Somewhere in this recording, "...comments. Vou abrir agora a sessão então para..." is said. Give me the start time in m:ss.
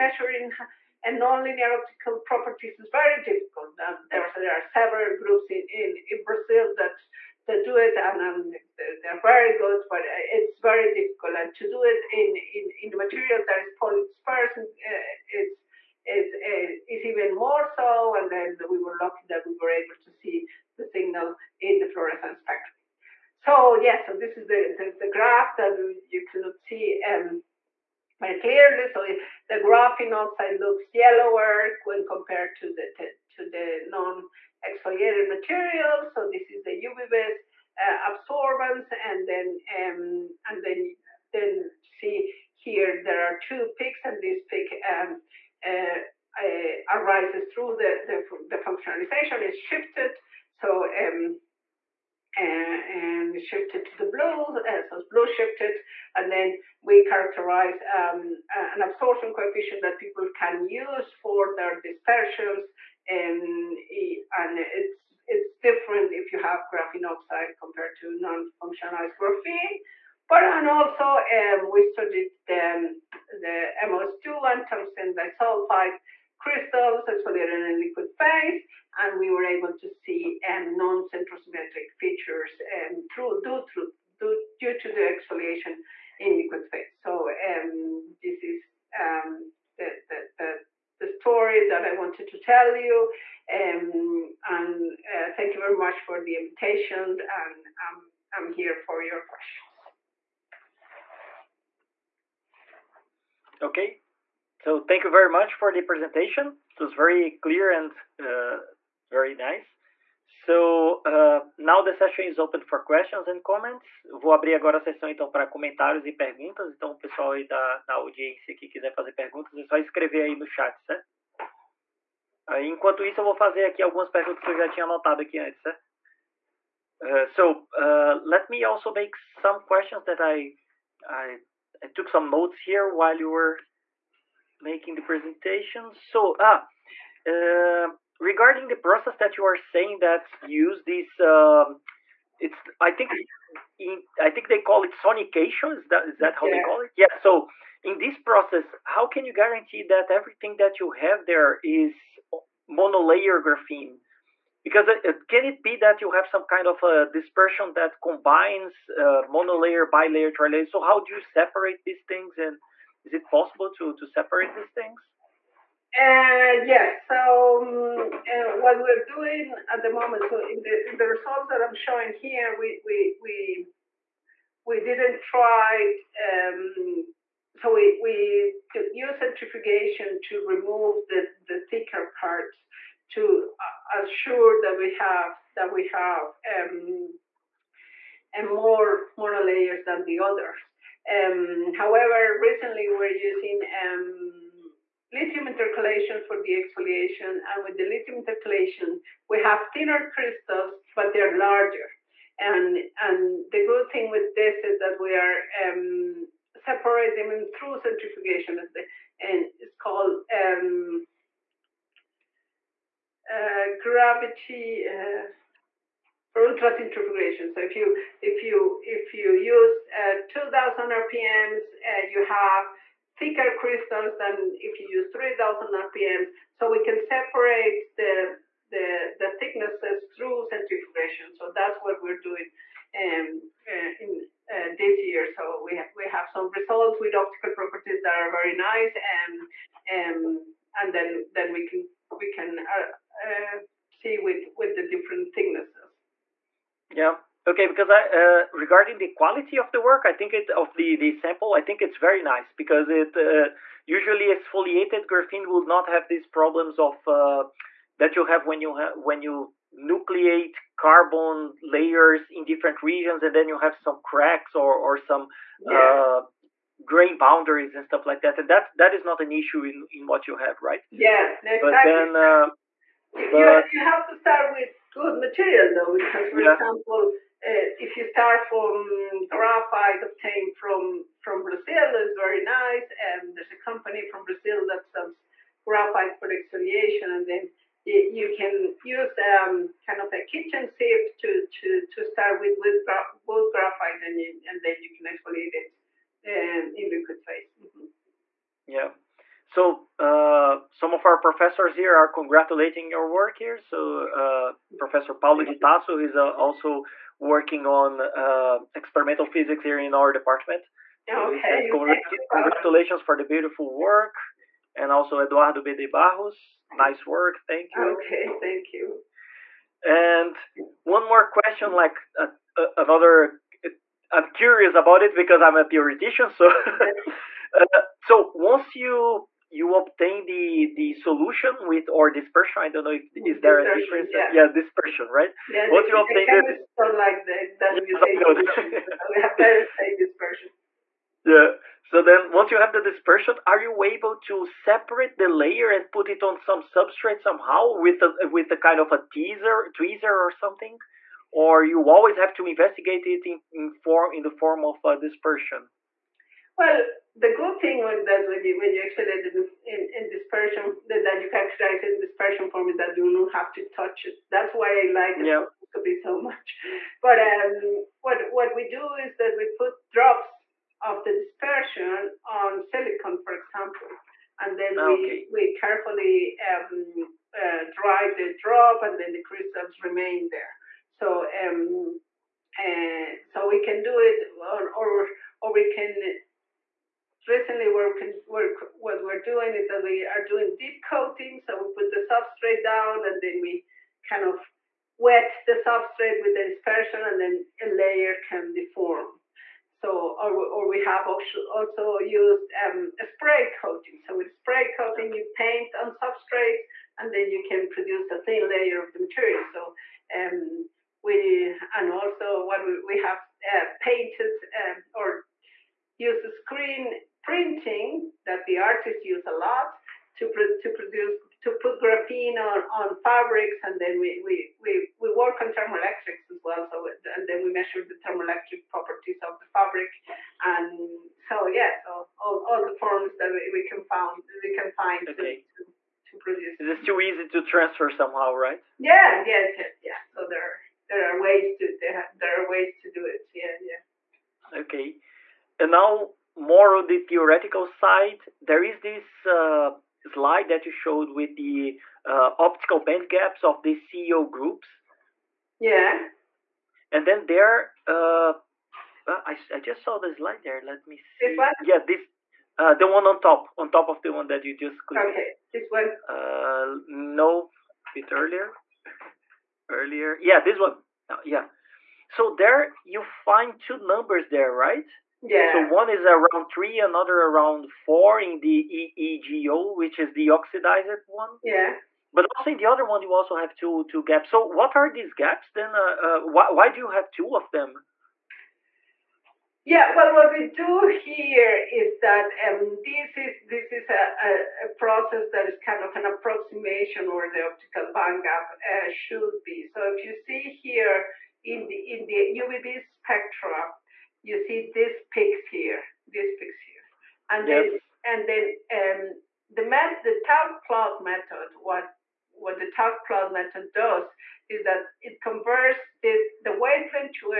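1:53.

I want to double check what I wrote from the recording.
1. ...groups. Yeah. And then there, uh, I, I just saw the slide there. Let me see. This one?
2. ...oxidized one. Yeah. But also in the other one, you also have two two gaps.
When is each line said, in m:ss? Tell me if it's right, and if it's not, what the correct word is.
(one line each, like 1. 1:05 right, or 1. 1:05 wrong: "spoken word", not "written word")
1. 7:34 right
2. 8:00 right.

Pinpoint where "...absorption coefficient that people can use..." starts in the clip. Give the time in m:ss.
0:58.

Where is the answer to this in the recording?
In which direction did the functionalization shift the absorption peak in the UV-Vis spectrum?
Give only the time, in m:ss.
0:55.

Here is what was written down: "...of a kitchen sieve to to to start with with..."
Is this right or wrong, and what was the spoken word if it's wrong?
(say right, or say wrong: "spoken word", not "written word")
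right.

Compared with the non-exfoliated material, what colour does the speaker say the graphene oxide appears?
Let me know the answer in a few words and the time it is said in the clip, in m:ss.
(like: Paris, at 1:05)
Yellower, at 0:30.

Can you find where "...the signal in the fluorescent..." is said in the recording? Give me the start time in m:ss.
0:20.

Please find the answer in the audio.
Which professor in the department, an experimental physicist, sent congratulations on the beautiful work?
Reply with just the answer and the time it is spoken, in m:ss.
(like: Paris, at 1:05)
Paulo de Tarso, at 5:05.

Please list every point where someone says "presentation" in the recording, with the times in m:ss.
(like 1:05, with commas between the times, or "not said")
1:45, 2:15.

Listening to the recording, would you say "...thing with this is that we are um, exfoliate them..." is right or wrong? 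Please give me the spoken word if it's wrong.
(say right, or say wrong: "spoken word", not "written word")
wrong: "separate", not "exfoliate".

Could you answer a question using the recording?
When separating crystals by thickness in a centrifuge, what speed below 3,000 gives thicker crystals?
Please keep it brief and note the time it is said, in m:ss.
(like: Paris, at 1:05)
2,000 RPM, at 3:40.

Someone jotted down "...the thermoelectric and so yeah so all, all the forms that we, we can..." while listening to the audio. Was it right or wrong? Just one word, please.
wrong.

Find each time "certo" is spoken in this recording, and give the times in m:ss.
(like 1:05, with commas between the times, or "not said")
2:00, 2:05.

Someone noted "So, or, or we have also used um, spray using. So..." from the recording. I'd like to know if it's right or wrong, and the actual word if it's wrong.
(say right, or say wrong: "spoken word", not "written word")
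wrong: "coating", not "using".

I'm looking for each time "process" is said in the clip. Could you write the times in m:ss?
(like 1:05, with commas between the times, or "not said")
2:18, 2:28, 8:14.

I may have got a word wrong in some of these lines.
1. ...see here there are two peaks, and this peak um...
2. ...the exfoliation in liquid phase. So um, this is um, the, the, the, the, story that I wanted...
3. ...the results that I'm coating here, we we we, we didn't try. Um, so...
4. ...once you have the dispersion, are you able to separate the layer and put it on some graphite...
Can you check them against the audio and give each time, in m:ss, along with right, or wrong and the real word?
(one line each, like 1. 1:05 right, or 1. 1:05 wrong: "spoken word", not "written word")
1. 0:41 right
2. 1:24 right
3. 2:50 wrong: "showing", not "coating"
4. 5:42 wrong: "substrate", not "graphite".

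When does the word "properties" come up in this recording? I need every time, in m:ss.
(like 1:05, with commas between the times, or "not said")
0:02, 3:57, 7:08.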